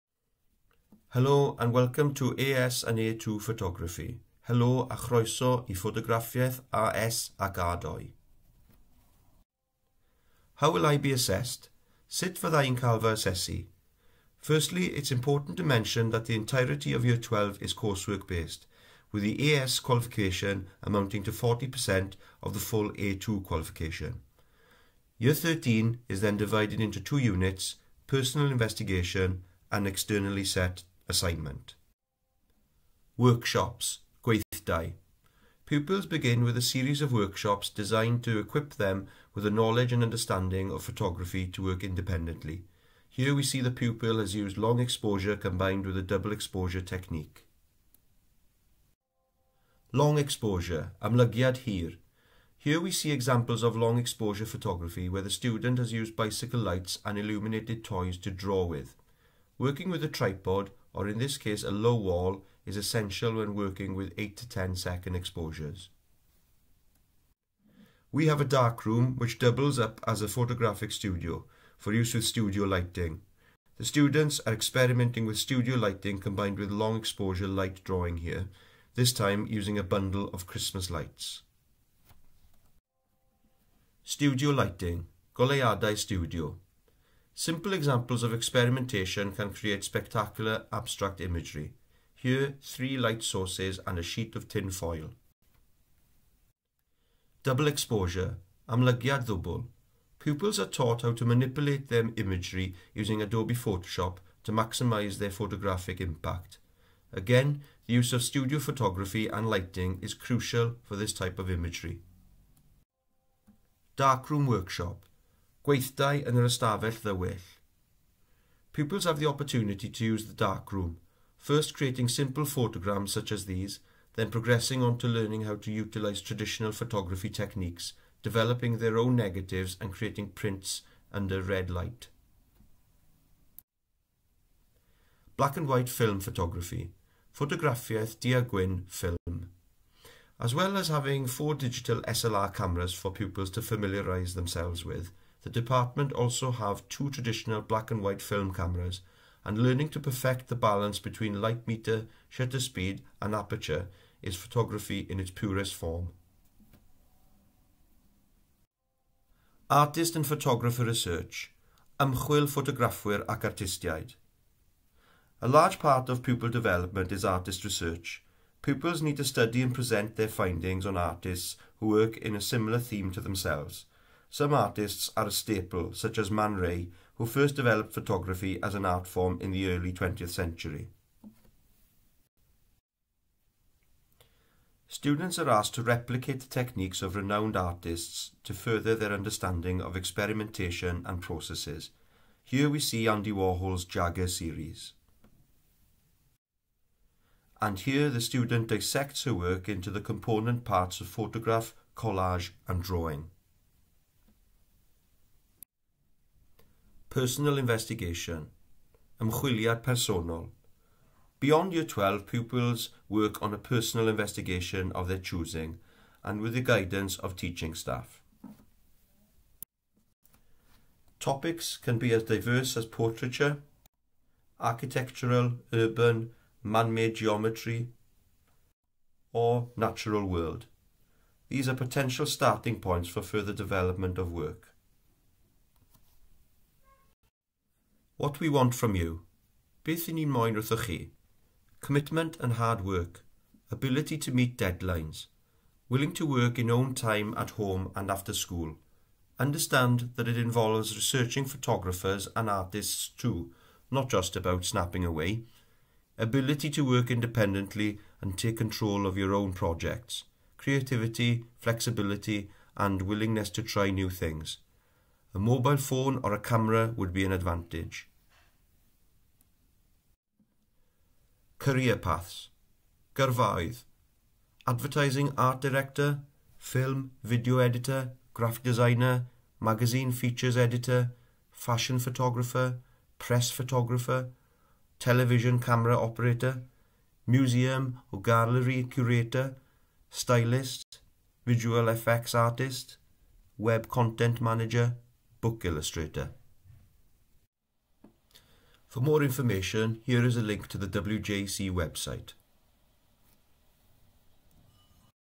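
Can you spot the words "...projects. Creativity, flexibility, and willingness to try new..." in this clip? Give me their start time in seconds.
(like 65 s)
259 s.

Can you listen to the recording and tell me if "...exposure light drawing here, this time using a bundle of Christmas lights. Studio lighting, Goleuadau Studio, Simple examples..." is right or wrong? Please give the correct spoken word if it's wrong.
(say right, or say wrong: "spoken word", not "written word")
right.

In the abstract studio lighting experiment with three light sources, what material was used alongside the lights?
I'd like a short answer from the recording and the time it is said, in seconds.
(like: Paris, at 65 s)
Tin foil, at 93 s.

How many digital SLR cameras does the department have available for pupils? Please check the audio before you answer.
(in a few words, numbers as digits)
4.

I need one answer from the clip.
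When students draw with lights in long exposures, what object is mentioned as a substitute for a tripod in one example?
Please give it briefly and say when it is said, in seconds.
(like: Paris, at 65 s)
A low wall, at 61 s.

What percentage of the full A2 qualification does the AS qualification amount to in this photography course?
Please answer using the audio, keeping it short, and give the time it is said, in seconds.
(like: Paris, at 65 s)
40%, at 21 s.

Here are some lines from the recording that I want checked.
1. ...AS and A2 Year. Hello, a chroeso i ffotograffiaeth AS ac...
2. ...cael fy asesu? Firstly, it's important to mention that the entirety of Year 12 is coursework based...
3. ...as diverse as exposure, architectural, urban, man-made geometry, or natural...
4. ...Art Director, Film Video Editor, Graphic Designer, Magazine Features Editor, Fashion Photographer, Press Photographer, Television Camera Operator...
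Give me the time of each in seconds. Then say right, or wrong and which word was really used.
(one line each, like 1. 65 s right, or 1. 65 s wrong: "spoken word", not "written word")
1. 2 s wrong: "Photography", not "Year"
2. 12 s right
3. 222 s wrong: "portraiture", not "exposure"
4. 275 s right.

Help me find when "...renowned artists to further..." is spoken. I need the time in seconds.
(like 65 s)
187 s.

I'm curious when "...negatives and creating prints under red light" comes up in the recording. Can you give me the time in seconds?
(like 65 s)
129 s.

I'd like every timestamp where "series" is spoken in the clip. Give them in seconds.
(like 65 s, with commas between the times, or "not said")
36 s, 194 s.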